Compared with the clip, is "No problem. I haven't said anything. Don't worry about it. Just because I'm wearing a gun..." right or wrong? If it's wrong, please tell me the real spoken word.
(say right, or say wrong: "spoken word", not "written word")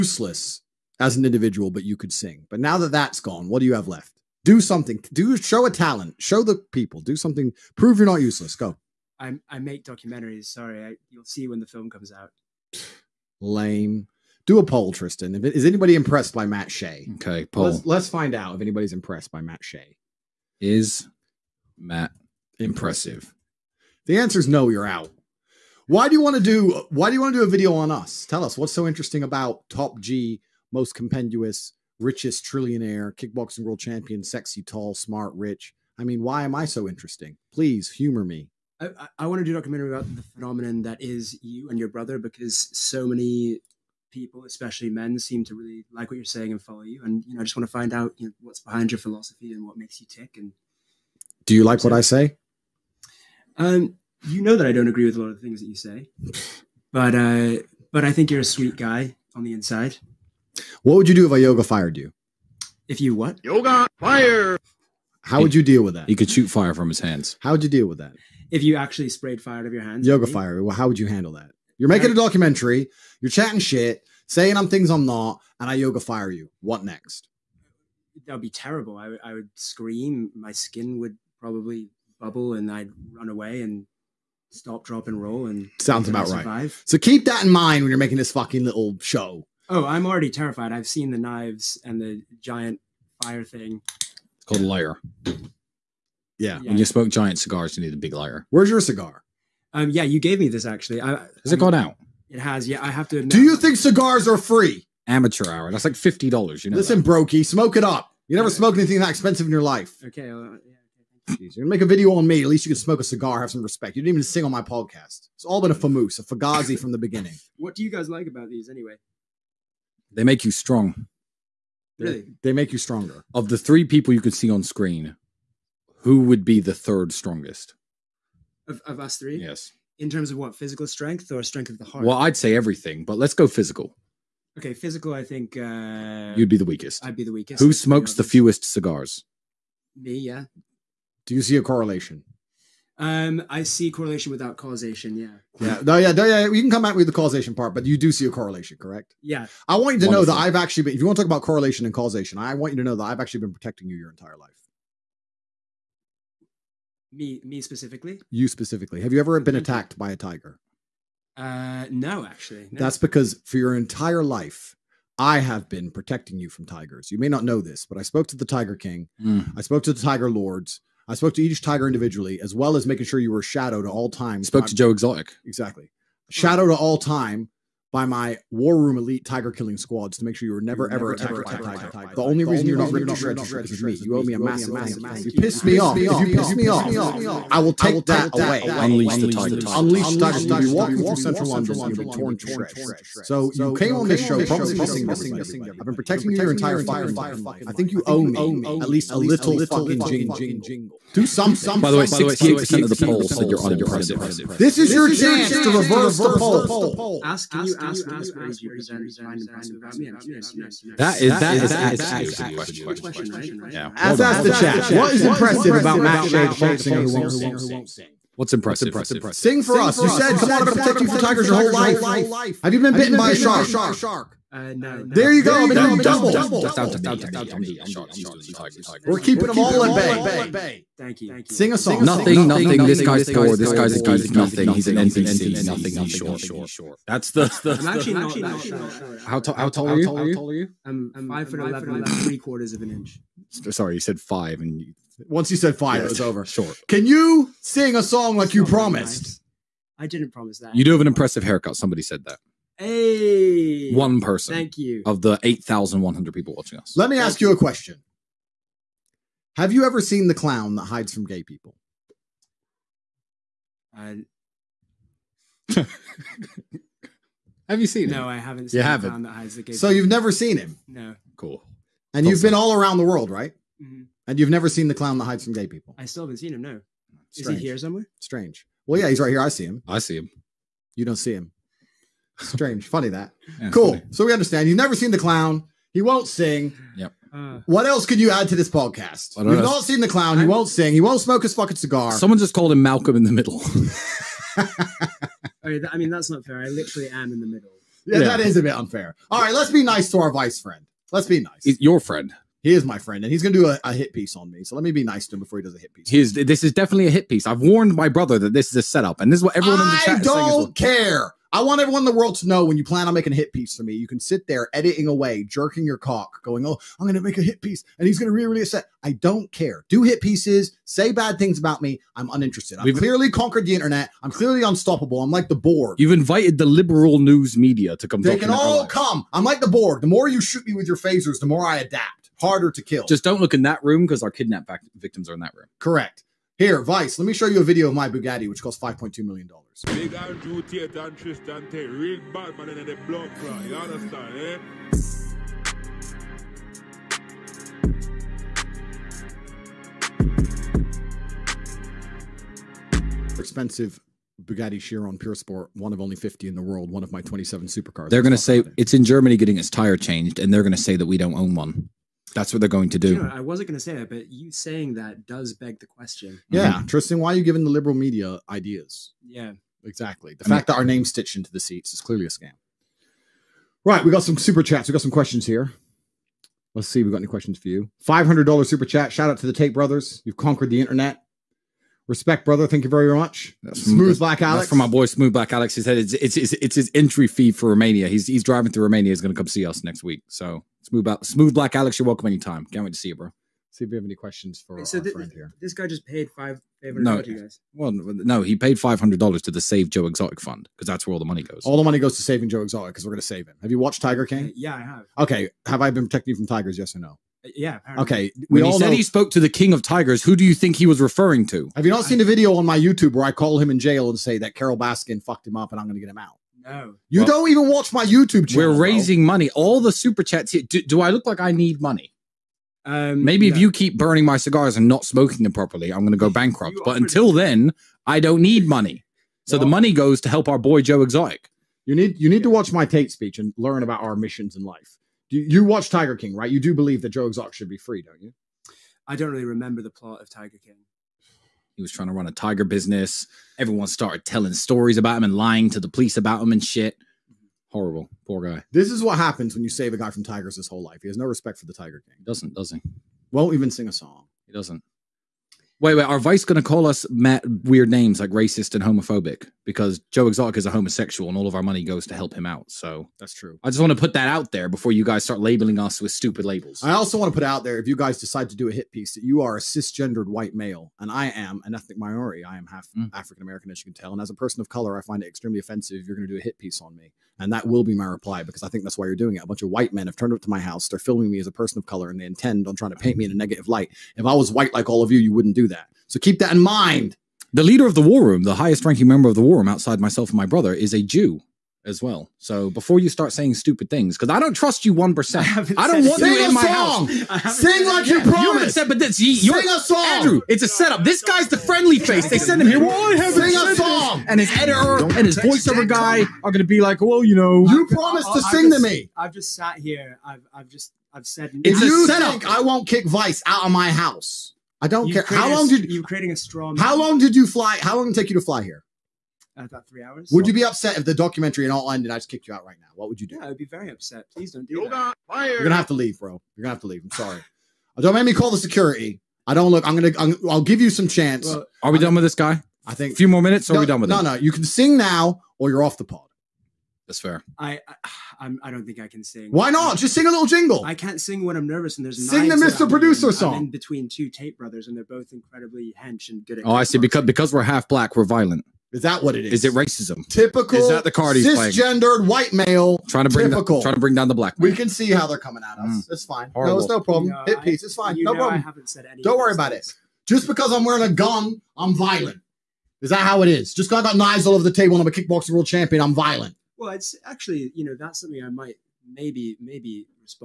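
right.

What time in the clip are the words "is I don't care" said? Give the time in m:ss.
5:10.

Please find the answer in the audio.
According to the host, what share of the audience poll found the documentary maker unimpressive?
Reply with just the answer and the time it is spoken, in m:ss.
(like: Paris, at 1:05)
68%, at 3:22.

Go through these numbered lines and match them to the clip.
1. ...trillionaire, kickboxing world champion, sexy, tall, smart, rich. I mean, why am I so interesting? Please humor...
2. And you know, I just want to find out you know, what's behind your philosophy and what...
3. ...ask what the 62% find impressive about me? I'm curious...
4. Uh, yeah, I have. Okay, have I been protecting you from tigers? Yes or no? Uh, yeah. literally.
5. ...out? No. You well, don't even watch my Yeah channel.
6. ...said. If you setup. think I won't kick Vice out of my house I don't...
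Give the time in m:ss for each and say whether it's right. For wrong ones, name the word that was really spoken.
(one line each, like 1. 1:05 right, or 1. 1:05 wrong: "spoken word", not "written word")
1. 0:32 right
2. 0:47 right
3. 3:27 wrong: "32", not "62"
4. 6:44 wrong: "apparently", not "literally"
5. 6:56 wrong: "YouTube", not "Yeah"
6. 8:31 right.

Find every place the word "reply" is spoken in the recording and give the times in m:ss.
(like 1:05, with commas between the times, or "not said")
7:58.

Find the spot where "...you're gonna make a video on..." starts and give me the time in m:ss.
1:51.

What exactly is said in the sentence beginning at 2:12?
Well, I'd say everything, but let's go physical.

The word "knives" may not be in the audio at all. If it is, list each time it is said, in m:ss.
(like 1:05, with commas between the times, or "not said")
1:31, 9:24.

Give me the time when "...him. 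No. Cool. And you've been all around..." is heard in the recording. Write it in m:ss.
4:30.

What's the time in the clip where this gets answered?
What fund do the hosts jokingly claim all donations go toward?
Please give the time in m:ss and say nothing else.
6:39.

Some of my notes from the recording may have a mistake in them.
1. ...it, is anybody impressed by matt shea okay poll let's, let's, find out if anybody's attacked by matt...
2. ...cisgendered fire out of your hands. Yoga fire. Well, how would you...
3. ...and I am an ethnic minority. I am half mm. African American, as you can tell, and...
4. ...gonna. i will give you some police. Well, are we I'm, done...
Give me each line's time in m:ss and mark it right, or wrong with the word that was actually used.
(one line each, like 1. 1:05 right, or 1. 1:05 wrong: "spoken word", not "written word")
1. 0:15 wrong: "impressed", not "attacked"
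2. 1:09 wrong: "sprayed", not "cisgendered"
3. 7:50 right
4. 8:49 wrong: "chance", not "police".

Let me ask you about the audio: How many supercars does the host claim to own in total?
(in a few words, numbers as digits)
27.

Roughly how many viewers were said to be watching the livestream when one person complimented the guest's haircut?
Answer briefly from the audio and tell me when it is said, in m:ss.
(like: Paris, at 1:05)
8,100, at 4:15.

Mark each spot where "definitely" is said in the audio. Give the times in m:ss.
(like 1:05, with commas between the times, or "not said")
5:06.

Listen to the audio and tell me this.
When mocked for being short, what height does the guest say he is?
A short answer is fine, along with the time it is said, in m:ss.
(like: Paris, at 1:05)
5 foot 11 and three quarters, at 4:01.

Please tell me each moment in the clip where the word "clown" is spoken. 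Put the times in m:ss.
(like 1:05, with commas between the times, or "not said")
4:20, 4:34, 4:45, 4:50.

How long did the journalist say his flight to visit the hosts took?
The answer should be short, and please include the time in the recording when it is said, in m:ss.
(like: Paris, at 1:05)
3 hours, at 8:39.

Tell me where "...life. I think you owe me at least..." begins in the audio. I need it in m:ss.
3:17.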